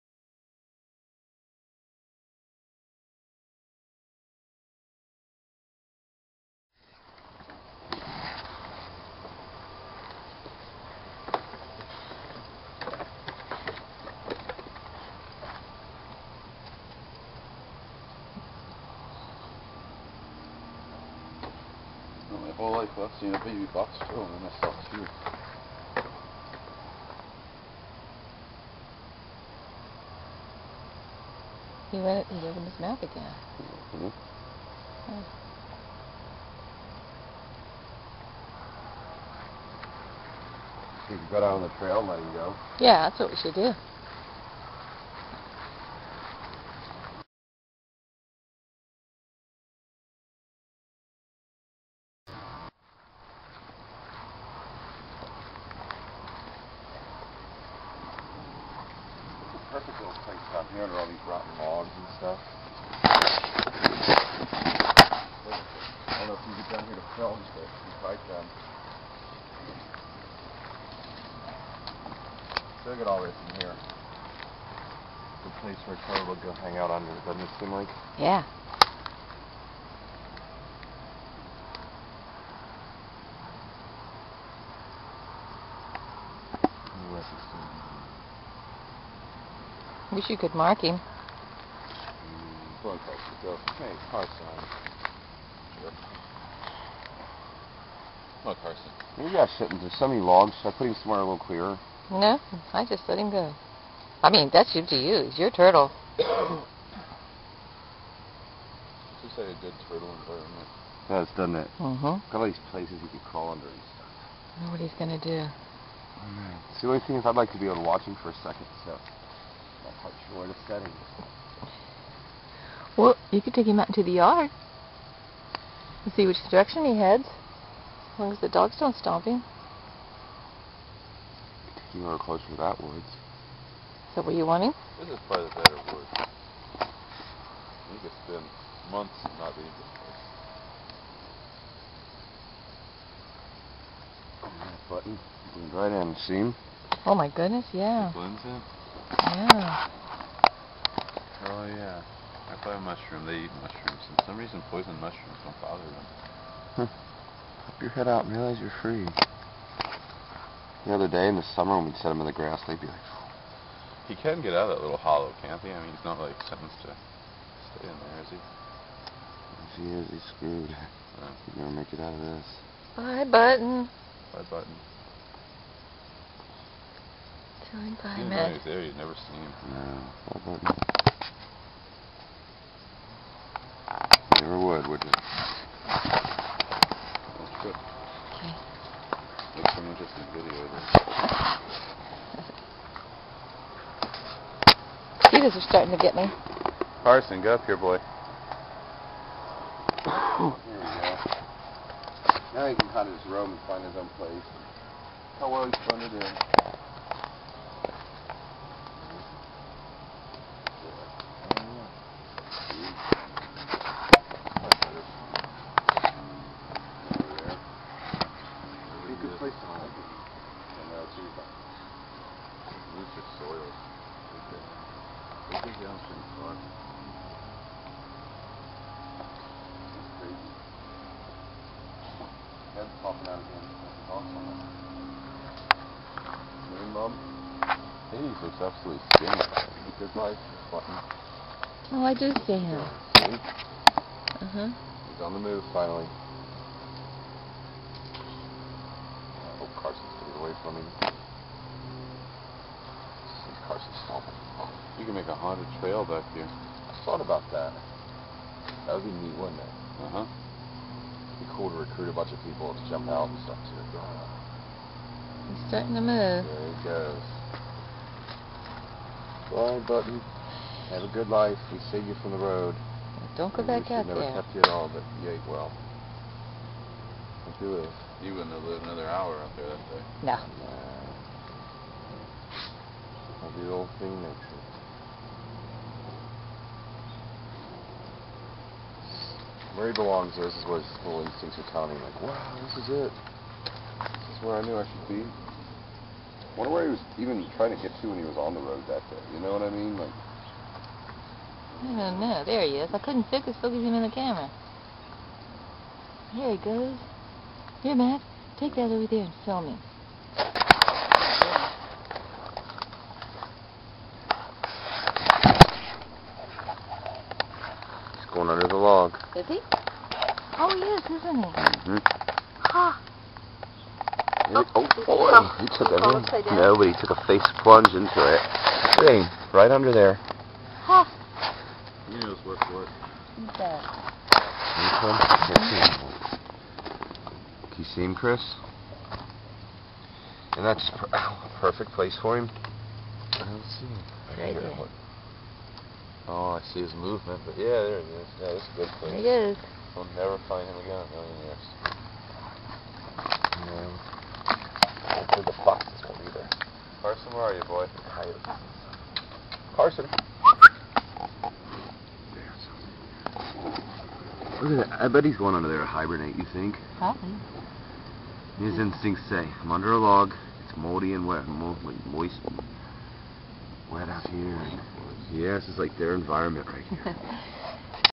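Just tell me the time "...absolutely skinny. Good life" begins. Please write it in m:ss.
3:58.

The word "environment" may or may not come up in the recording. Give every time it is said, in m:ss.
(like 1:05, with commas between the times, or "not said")
1:50, 6:16.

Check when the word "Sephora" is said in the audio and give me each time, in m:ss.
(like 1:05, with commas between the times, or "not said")
not said.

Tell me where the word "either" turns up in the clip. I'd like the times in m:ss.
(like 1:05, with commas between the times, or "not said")
5:56.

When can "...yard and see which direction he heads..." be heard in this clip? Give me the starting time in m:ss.
2:04.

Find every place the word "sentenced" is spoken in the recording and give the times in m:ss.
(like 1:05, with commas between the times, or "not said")
2:46.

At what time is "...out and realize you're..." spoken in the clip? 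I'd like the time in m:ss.
2:38.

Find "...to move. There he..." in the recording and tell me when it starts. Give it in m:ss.
4:25.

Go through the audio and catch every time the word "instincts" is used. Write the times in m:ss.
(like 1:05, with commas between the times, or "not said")
4:51, 6:08.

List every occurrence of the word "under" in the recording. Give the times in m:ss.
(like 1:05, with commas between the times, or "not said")
1:00, 1:16, 1:53, 5:29, 6:05, 6:09.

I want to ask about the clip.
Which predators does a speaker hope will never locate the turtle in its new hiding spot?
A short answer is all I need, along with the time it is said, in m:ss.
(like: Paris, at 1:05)
foxes, at 5:55.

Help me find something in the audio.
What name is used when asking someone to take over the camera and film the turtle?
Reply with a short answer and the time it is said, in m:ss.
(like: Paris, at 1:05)
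Matt, at 5:07.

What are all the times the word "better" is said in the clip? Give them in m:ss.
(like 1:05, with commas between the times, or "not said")
2:15.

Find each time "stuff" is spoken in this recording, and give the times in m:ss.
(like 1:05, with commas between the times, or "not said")
1:02, 1:53, 4:23.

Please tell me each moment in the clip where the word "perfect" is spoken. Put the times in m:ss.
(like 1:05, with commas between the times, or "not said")
0:59, 5:41.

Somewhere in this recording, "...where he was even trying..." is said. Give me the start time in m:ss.
4:56.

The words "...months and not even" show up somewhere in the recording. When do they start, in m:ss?
2:18.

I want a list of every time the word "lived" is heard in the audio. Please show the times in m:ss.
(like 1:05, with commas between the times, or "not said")
4:38.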